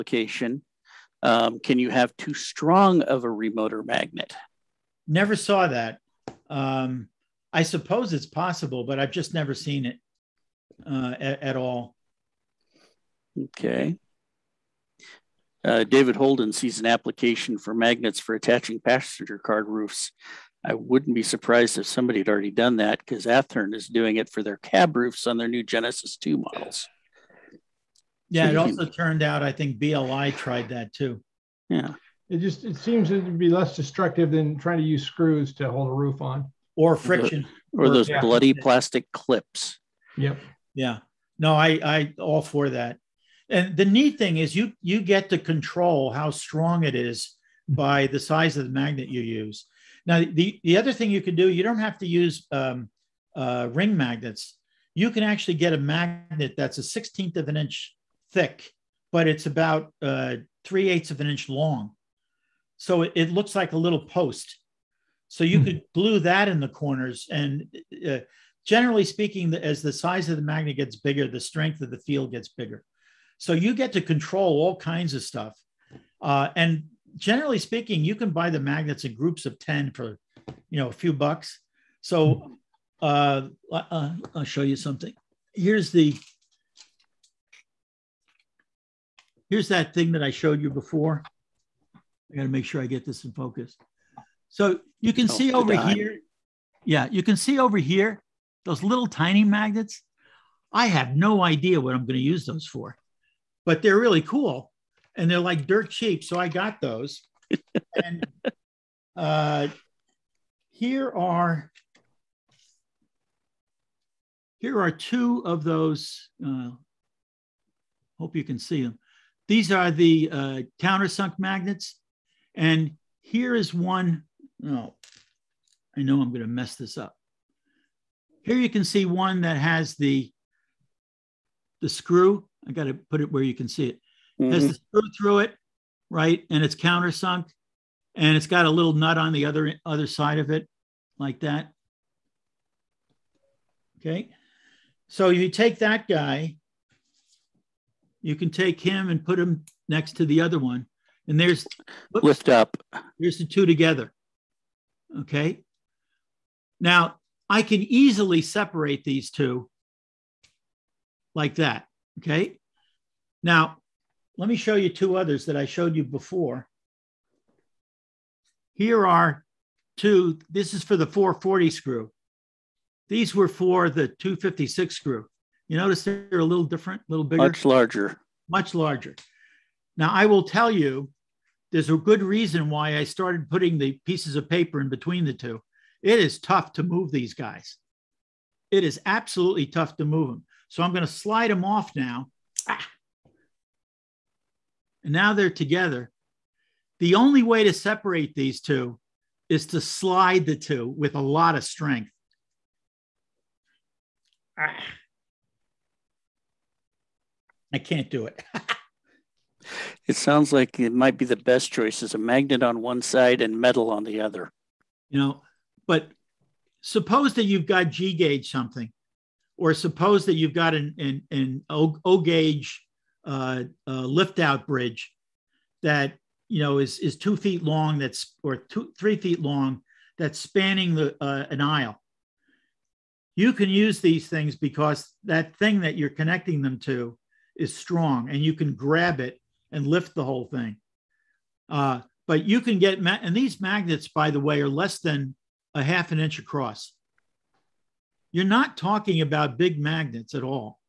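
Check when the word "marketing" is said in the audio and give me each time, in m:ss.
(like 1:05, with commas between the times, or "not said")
not said.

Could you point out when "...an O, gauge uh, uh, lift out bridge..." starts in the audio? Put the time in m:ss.
3:41.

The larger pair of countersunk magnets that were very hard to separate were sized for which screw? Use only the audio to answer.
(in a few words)
4-40.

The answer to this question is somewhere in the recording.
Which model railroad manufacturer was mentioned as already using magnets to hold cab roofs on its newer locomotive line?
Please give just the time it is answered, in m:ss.
0:23.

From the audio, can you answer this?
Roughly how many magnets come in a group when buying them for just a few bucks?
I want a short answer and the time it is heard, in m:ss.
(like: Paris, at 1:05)
10, at 1:19.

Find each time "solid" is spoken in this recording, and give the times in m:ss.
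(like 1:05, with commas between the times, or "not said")
not said.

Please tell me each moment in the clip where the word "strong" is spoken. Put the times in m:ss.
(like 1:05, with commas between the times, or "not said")
0:02, 0:46, 3:57.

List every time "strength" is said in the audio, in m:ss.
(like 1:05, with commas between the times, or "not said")
1:11, 3:21.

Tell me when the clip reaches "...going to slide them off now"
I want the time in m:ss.
3:10.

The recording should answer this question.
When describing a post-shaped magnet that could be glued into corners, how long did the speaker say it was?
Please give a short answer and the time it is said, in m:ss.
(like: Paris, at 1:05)
3/8 of an inch, at 1:00.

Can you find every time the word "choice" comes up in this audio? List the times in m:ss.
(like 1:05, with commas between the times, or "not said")
3:31.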